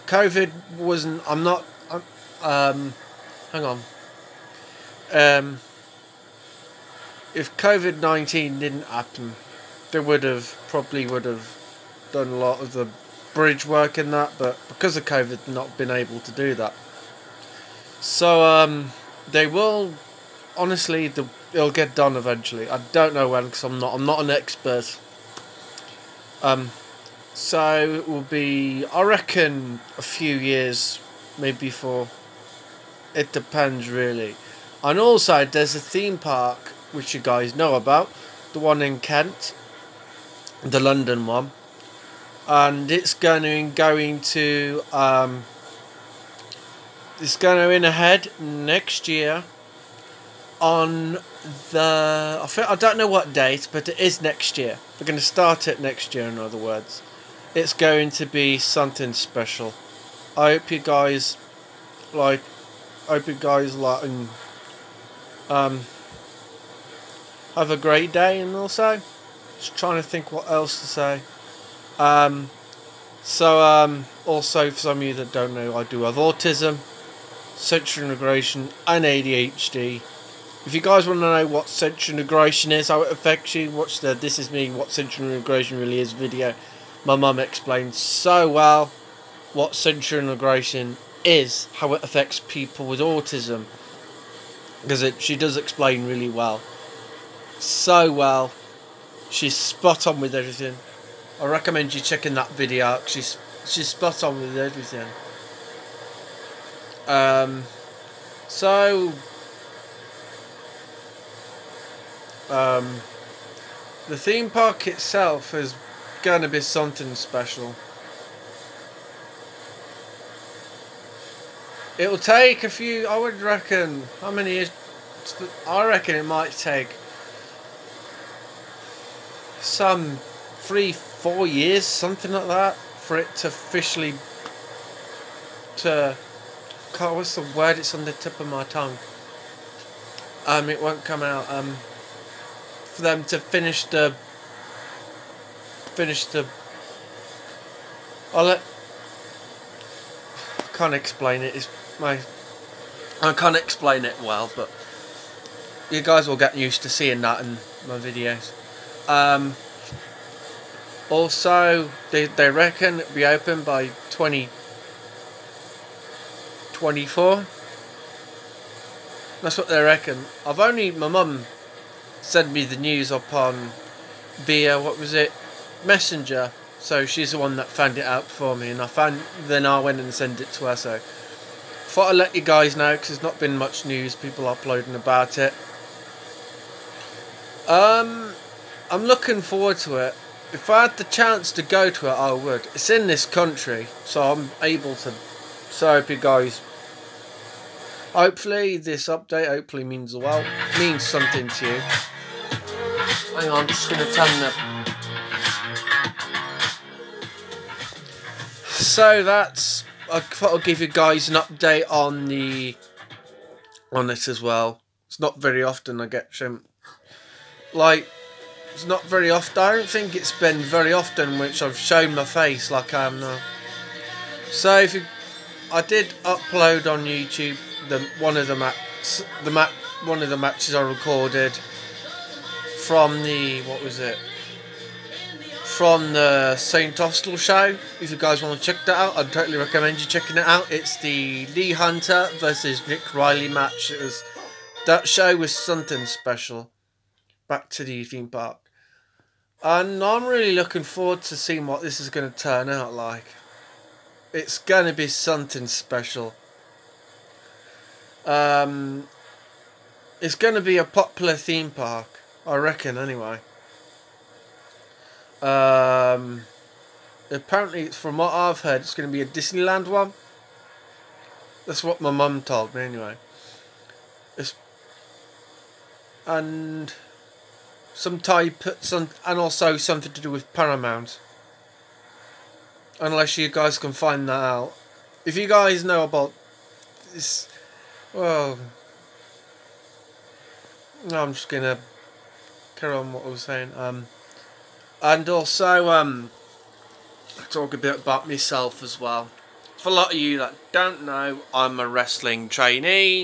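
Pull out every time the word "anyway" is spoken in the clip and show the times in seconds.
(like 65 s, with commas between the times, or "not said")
262 s, 272 s.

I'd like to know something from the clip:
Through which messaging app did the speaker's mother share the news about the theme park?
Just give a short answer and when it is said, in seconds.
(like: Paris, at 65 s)
Messenger, at 175 s.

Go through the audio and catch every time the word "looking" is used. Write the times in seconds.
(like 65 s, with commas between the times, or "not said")
189 s, 250 s.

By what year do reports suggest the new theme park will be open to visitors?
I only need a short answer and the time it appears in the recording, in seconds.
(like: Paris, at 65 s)
2024, at 164 s.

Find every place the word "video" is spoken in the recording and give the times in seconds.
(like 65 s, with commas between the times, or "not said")
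86 s, 102 s, 157 s.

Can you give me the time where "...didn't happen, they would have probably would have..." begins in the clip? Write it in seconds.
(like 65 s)
8 s.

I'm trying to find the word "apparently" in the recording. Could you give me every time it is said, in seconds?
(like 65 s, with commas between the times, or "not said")
267 s.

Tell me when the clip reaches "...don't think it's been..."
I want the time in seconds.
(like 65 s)
219 s.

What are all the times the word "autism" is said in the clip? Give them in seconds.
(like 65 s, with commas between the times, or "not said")
76 s, 92 s.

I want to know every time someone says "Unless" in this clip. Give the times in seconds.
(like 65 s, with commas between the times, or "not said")
282 s.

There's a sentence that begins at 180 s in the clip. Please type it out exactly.
So thought I'd let you guys know because there's not been much news, people uploading about it.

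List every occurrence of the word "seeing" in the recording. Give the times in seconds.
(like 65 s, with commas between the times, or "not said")
156 s, 251 s.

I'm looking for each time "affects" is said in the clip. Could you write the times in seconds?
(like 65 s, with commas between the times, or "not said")
83 s, 92 s.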